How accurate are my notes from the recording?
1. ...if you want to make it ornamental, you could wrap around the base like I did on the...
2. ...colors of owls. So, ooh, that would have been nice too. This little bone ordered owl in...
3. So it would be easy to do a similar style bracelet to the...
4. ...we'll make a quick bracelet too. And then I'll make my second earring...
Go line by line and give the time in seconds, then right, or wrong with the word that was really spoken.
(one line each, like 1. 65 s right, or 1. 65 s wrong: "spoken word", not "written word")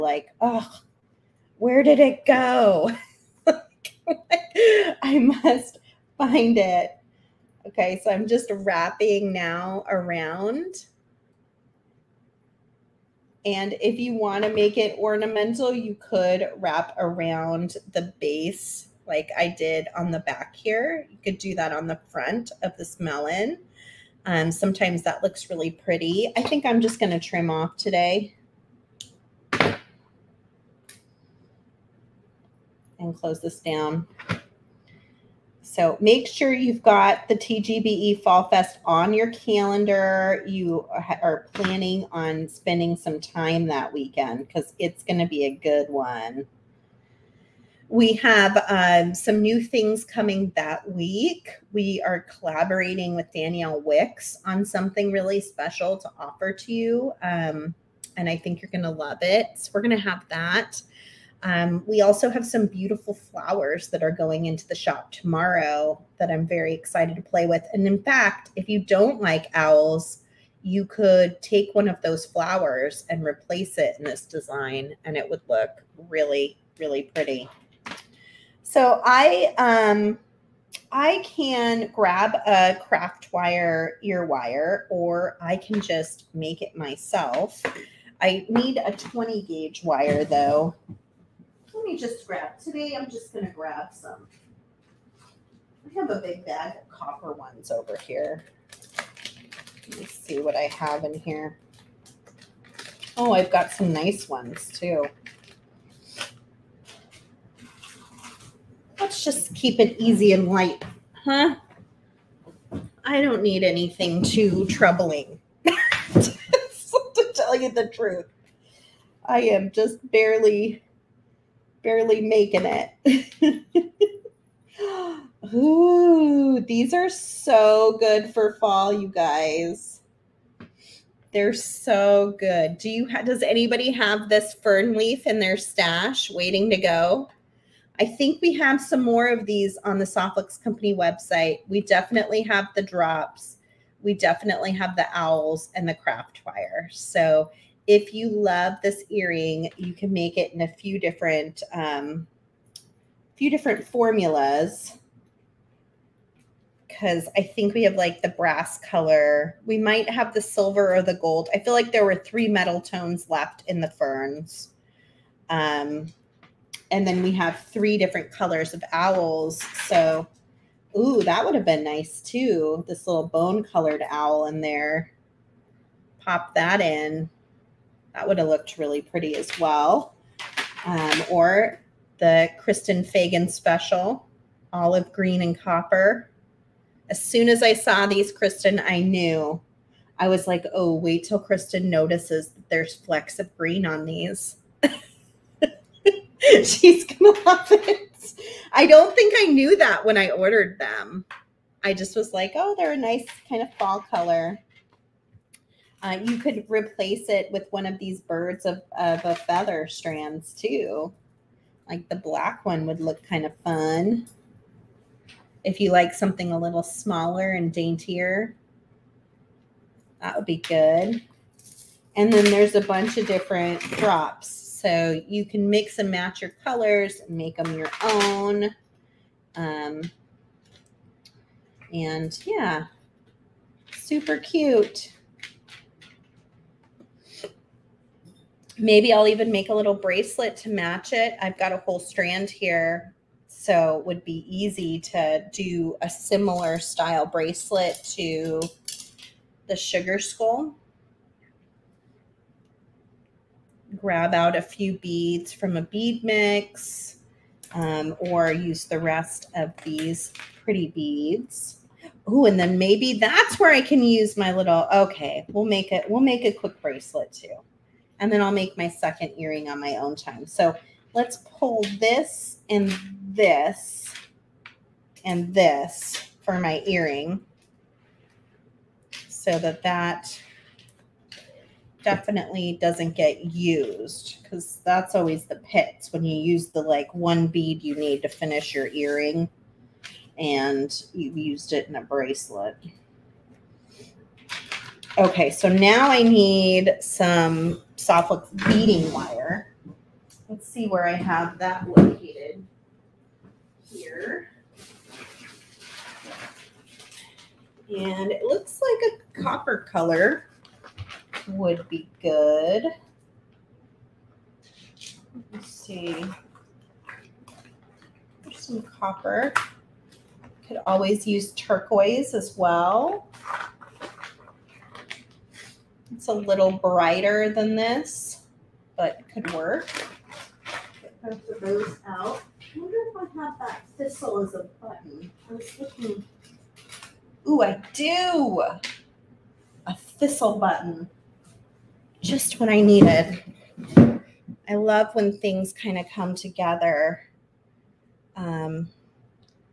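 1. 13 s right
2. 168 s wrong: "colored", not "ordered"
3. 243 s right
4. 266 s right.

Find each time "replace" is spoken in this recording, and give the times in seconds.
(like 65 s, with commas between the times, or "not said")
73 s, 206 s.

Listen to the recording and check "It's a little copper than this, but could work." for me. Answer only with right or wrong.
wrong.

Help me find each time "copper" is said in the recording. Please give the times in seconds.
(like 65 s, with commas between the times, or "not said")
96 s, 185 s, 309 s, 318 s.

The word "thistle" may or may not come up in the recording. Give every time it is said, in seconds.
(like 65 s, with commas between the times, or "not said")
333 s, 339 s.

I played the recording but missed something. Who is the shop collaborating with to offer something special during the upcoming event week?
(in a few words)
Danielle Wicks.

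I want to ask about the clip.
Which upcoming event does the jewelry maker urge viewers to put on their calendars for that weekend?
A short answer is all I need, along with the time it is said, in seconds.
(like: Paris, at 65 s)
TGBE Fall Fest, at 37 s.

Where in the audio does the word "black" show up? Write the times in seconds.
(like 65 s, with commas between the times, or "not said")
212 s.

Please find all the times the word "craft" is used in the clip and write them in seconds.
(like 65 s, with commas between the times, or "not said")
82 s, 145 s.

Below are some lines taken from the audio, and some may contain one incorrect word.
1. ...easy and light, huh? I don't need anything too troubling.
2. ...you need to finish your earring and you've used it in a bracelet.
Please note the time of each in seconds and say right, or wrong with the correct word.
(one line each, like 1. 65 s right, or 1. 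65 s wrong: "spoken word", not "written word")
1. 110 s right
2. 287 s right.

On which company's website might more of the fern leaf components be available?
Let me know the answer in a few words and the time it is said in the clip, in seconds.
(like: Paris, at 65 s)
Soft Flex Company, at 140 s.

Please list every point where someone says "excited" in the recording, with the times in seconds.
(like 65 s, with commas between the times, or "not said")
66 s.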